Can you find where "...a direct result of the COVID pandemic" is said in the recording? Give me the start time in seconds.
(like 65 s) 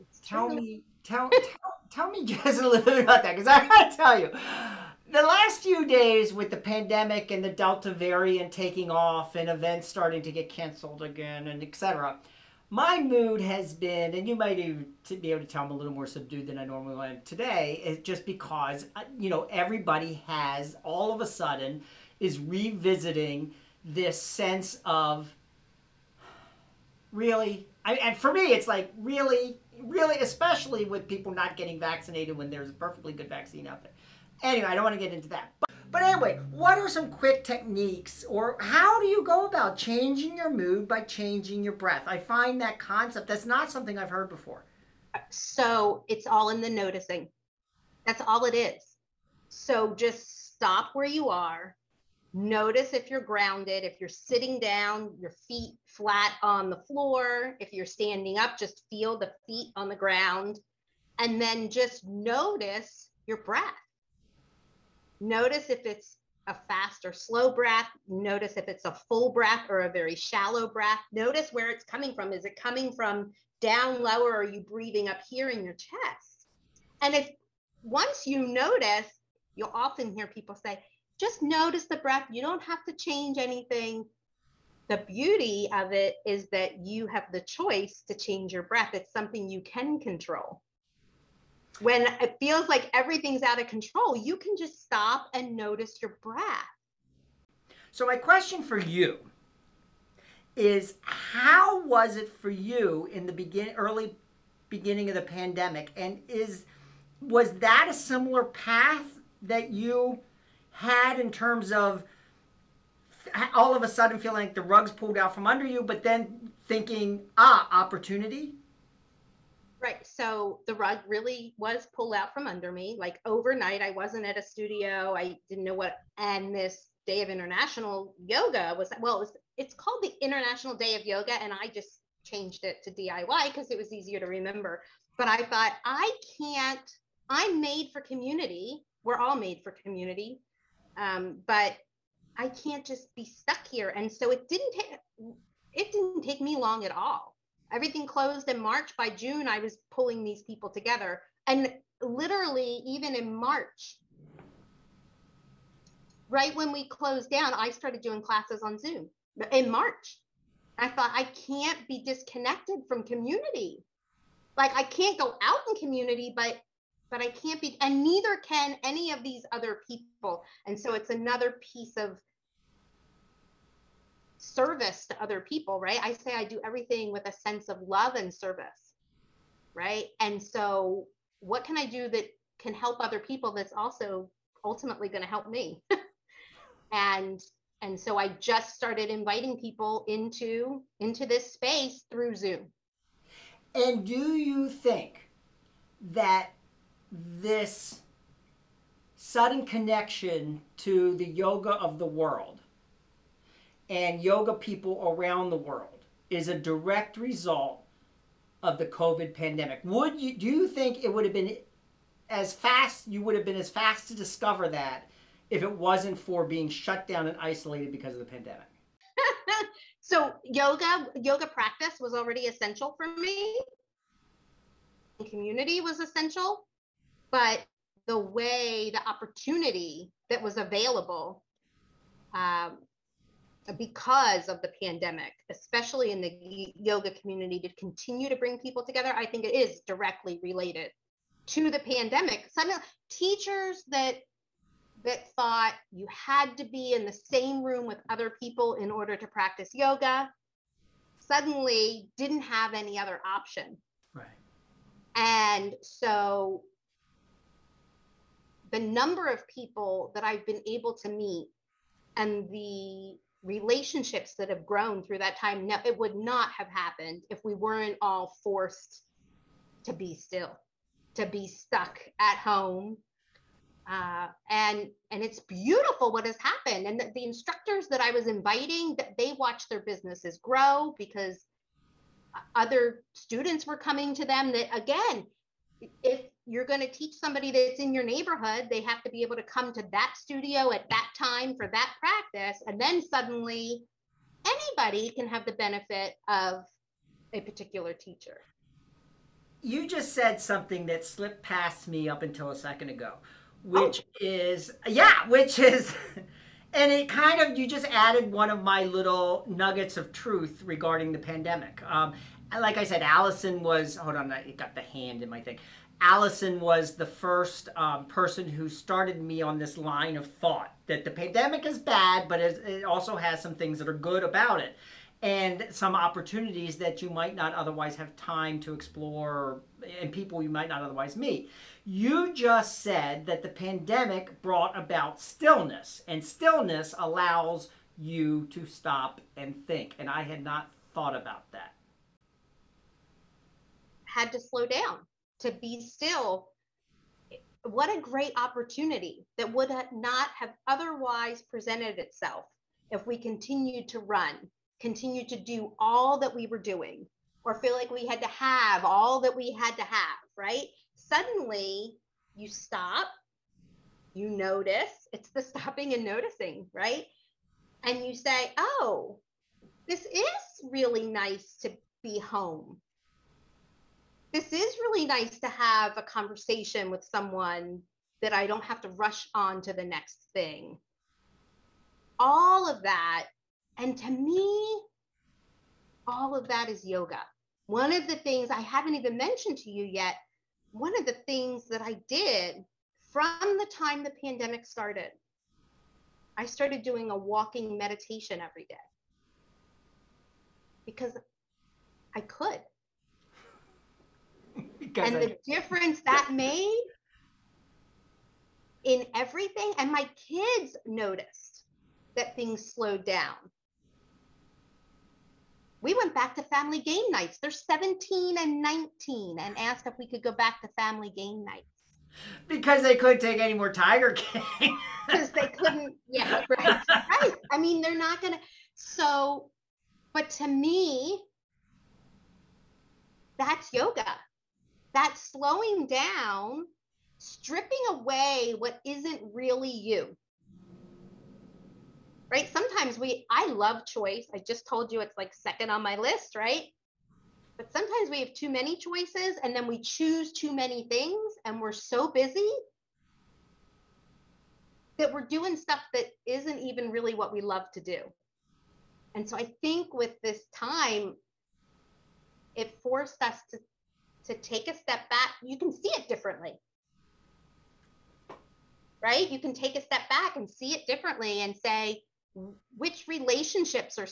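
206 s.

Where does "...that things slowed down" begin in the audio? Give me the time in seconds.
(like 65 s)
412 s.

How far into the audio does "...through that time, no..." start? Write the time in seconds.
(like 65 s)
265 s.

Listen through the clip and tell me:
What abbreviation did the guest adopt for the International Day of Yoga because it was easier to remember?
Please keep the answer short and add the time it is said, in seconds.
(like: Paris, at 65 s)
DIY, at 132 s.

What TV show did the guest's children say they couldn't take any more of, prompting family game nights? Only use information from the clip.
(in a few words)
Tiger King.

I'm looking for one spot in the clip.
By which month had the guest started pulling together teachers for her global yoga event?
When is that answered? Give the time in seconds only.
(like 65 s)
149 s.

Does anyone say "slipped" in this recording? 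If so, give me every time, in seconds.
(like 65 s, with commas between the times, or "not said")
301 s.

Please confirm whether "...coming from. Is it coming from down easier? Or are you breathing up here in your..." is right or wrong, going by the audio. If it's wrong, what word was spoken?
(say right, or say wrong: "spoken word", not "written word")
wrong: "lower", not "easier".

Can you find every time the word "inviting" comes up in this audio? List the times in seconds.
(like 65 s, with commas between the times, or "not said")
189 s, 278 s.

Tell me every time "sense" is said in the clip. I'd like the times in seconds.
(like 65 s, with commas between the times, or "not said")
24 s, 177 s.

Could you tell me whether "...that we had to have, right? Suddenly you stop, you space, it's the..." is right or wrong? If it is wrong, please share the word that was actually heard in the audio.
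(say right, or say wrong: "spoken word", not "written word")
wrong: "notice", not "space".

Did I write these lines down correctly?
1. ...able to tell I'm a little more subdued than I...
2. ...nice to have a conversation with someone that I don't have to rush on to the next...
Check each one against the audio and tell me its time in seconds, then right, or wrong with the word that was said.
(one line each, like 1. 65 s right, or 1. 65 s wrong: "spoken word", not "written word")
1. 15 s right
2. 375 s right.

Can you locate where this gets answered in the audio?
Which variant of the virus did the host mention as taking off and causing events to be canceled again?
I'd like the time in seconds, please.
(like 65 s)
7 s.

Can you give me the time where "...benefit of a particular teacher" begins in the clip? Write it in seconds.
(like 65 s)
295 s.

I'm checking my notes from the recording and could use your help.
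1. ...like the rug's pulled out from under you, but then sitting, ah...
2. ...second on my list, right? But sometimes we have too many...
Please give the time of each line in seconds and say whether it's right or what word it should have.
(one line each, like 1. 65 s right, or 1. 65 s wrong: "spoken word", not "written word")
1. 114 s wrong: "thinking", not "sitting"
2. 445 s right.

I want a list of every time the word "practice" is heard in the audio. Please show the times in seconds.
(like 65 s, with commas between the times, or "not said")
221 s, 249 s, 291 s.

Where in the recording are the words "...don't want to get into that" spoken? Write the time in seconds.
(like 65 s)
34 s.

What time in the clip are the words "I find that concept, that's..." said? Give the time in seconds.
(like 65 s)
42 s.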